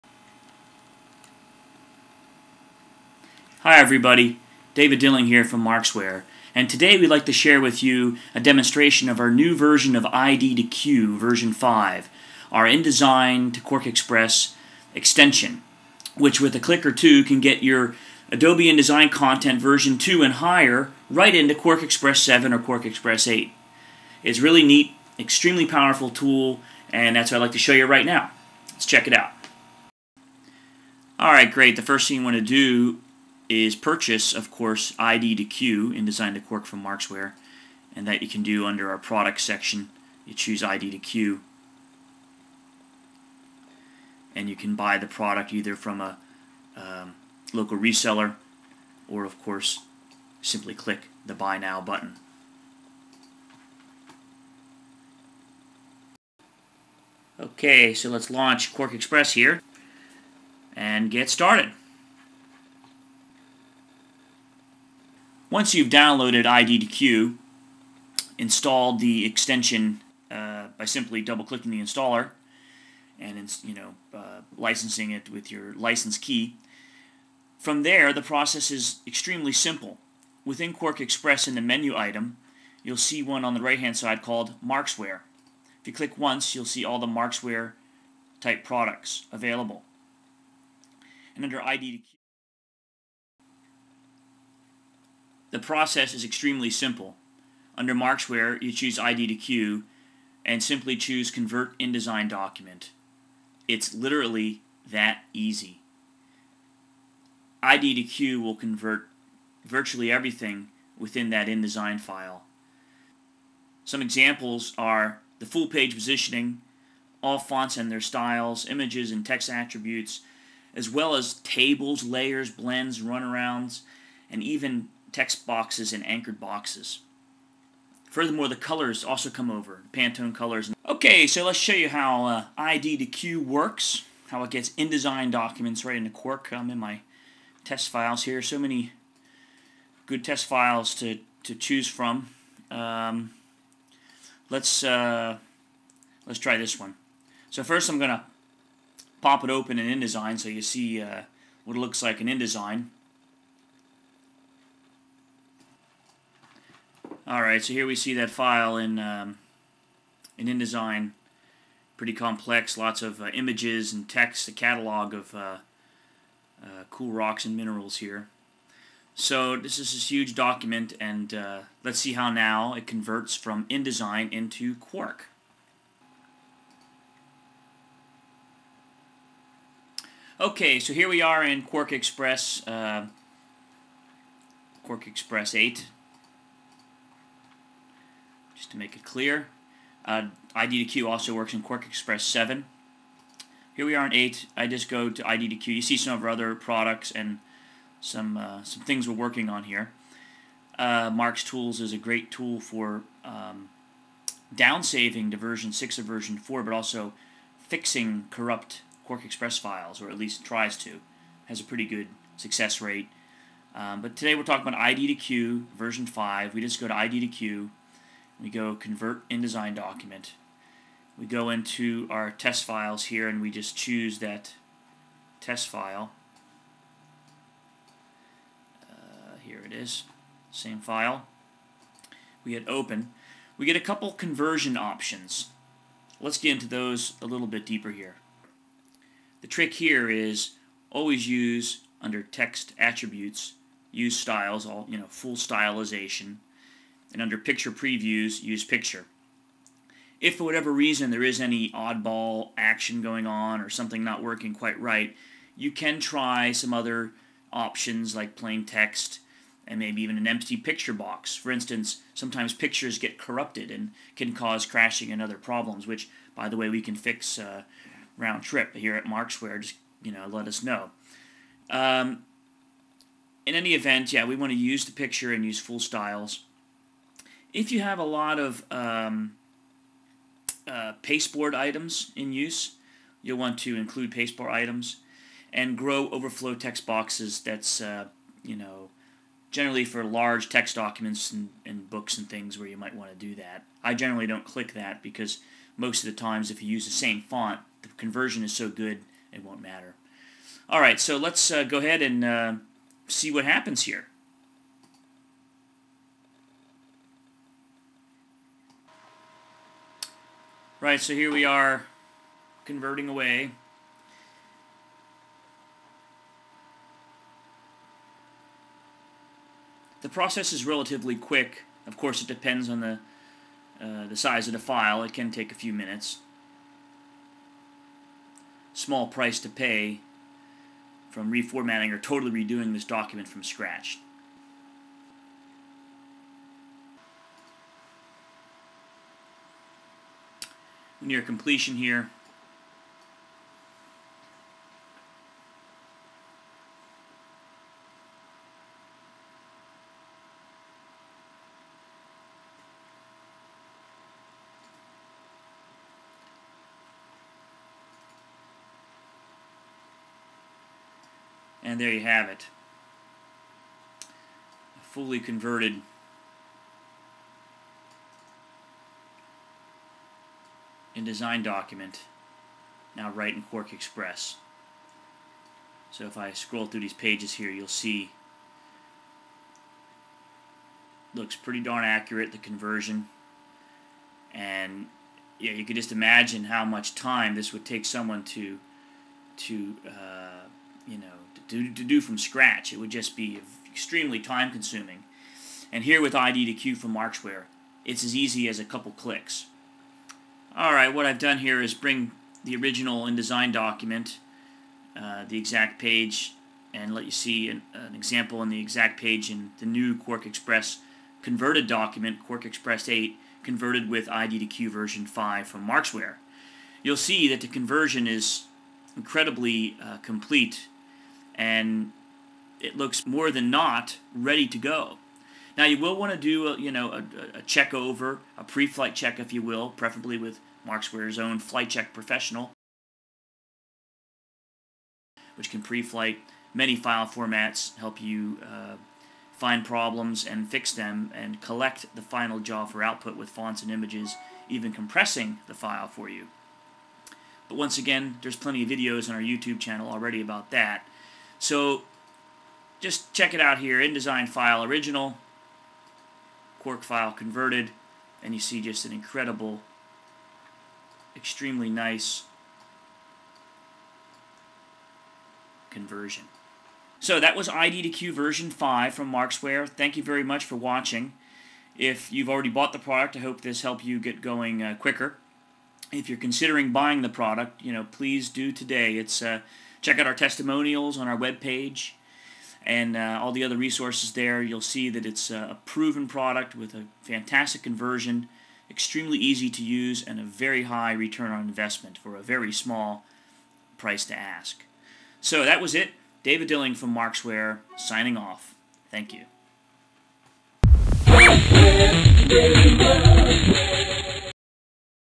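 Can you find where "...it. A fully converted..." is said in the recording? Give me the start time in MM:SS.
06:02.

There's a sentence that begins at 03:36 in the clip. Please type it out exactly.
We just go to ID Q we go convert InDesign document.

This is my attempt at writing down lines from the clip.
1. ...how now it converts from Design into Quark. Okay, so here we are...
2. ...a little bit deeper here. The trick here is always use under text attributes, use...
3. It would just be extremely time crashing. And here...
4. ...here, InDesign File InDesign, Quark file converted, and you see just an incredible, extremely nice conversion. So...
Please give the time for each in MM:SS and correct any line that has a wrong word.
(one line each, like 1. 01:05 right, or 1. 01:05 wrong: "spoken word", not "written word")
1. 02:52 wrong: "InDesign", not "Design"
2. 03:57 right
3. 06:32 wrong: "consuming", not "crashing"
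4. 07:33 wrong: "Original", not "InDesign".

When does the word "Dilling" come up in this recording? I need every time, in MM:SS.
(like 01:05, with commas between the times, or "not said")
00:04, 08:16.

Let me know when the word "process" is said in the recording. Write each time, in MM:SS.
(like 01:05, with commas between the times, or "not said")
01:18, 01:35, 05:20.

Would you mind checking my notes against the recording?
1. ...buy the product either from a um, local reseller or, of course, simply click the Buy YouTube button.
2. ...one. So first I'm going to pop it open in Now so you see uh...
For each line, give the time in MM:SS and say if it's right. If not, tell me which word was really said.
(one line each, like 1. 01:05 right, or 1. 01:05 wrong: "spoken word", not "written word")
1. 00:44 wrong: "Now", not "YouTube"
2. 02:26 wrong: "InDesign", not "Now".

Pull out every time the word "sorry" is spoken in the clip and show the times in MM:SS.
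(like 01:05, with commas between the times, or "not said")
not said.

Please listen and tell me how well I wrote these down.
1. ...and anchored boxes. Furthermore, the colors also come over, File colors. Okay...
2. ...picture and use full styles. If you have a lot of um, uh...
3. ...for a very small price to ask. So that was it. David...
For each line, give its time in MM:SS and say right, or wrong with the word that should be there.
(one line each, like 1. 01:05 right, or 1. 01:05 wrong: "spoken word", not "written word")
1. 02:05 wrong: "Pantone", not "File"
2. 04:34 right
3. 08:11 right.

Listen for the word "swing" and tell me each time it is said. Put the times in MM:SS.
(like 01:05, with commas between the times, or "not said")
not said.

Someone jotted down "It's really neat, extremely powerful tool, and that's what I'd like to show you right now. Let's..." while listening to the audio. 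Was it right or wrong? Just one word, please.
right.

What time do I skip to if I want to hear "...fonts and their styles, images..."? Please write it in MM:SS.
01:57.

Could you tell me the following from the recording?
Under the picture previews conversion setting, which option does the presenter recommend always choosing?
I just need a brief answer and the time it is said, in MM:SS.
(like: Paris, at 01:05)
Use picture, at 04:08.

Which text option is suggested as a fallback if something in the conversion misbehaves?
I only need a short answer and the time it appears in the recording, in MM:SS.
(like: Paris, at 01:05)
Plain text, at 04:18.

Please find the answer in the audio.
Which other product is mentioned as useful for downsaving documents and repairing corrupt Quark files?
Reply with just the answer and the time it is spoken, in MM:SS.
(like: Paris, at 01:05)
MarkzTools, at 03:21.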